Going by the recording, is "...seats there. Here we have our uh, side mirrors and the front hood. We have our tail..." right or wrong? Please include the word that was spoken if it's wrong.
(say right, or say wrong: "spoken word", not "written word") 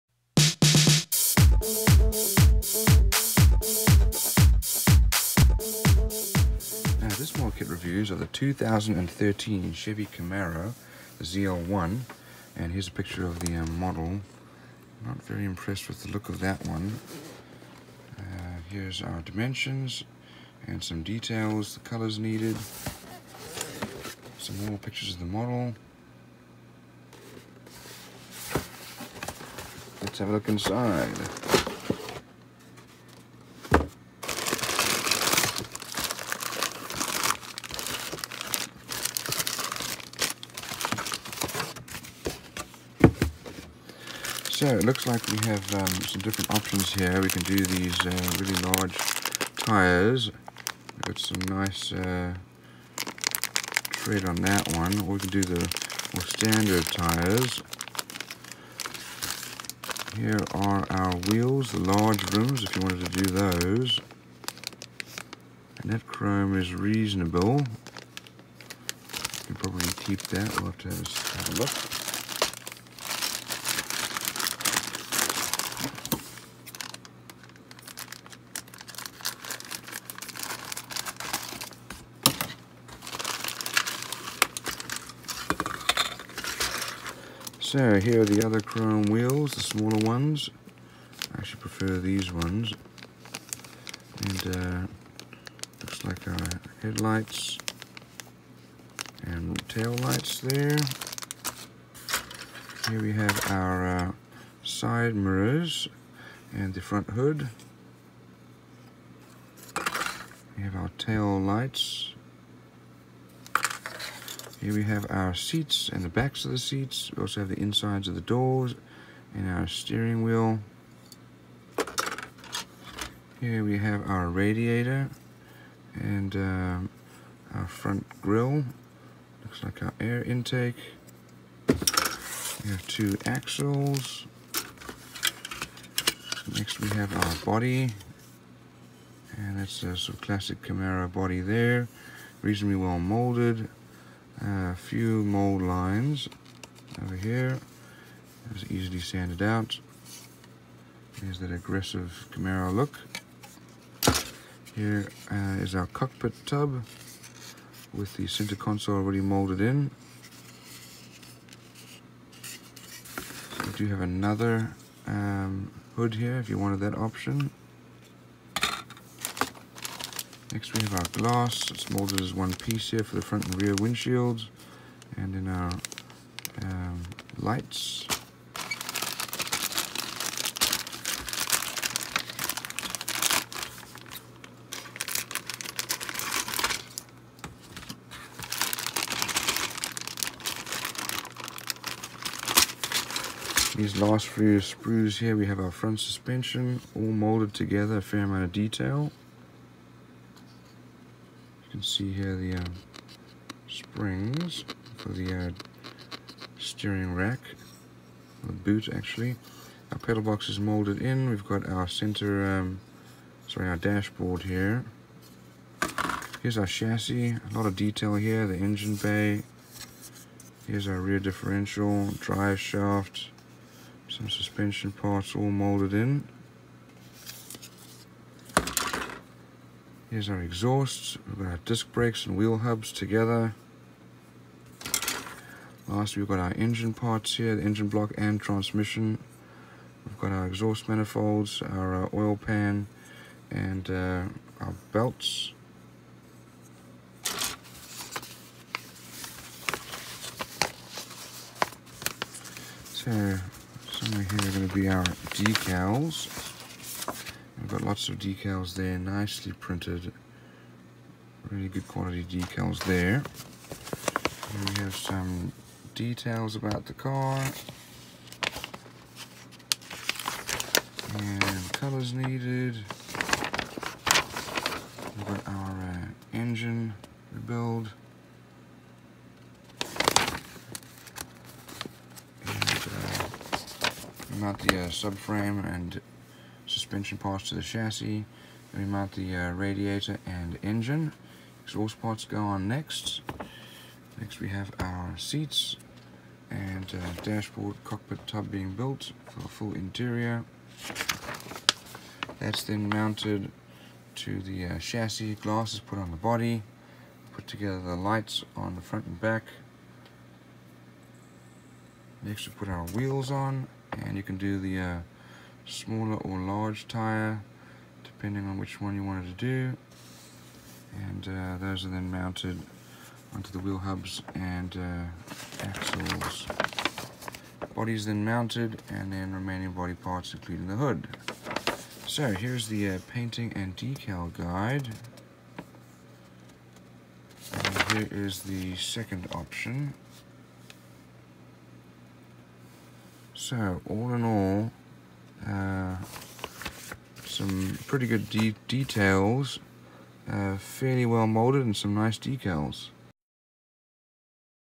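wrong: "lights", not "seats".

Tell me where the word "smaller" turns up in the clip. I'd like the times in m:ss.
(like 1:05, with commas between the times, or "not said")
1:29, 5:15.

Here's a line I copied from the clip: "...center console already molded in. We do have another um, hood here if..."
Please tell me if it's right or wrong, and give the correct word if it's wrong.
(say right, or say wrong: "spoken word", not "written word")
right.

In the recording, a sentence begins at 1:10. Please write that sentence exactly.
We'll have to have a look.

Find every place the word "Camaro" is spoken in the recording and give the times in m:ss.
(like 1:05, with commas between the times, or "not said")
0:10, 2:20, 2:32.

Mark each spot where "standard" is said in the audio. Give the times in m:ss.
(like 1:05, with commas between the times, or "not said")
0:56.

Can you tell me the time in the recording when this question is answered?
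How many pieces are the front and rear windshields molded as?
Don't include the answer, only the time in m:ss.
2:52.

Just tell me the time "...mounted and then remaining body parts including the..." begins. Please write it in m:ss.
5:28.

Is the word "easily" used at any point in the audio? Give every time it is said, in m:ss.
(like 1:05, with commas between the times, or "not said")
2:28.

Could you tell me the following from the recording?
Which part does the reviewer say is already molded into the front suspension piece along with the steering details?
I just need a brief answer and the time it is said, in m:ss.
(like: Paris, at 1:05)
pedal box, at 3:29.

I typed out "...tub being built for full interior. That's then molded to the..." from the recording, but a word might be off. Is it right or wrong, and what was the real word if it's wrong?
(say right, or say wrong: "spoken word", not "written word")
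wrong: "mounted", not "molded".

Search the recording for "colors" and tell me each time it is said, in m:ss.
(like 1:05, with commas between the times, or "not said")
0:21, 4:31.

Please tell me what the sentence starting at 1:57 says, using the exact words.
We also have the insides of the doors and our steering wheel.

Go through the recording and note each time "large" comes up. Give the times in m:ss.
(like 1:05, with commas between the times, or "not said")
0:48, 1:01, 5:16.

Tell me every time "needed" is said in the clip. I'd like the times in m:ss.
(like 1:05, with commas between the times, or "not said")
0:22, 4:32.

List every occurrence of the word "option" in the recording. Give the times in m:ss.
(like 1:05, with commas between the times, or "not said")
0:46, 2:46, 5:39.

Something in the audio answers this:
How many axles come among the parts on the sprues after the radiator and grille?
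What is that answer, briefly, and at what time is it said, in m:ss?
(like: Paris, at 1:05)
2, at 2:12.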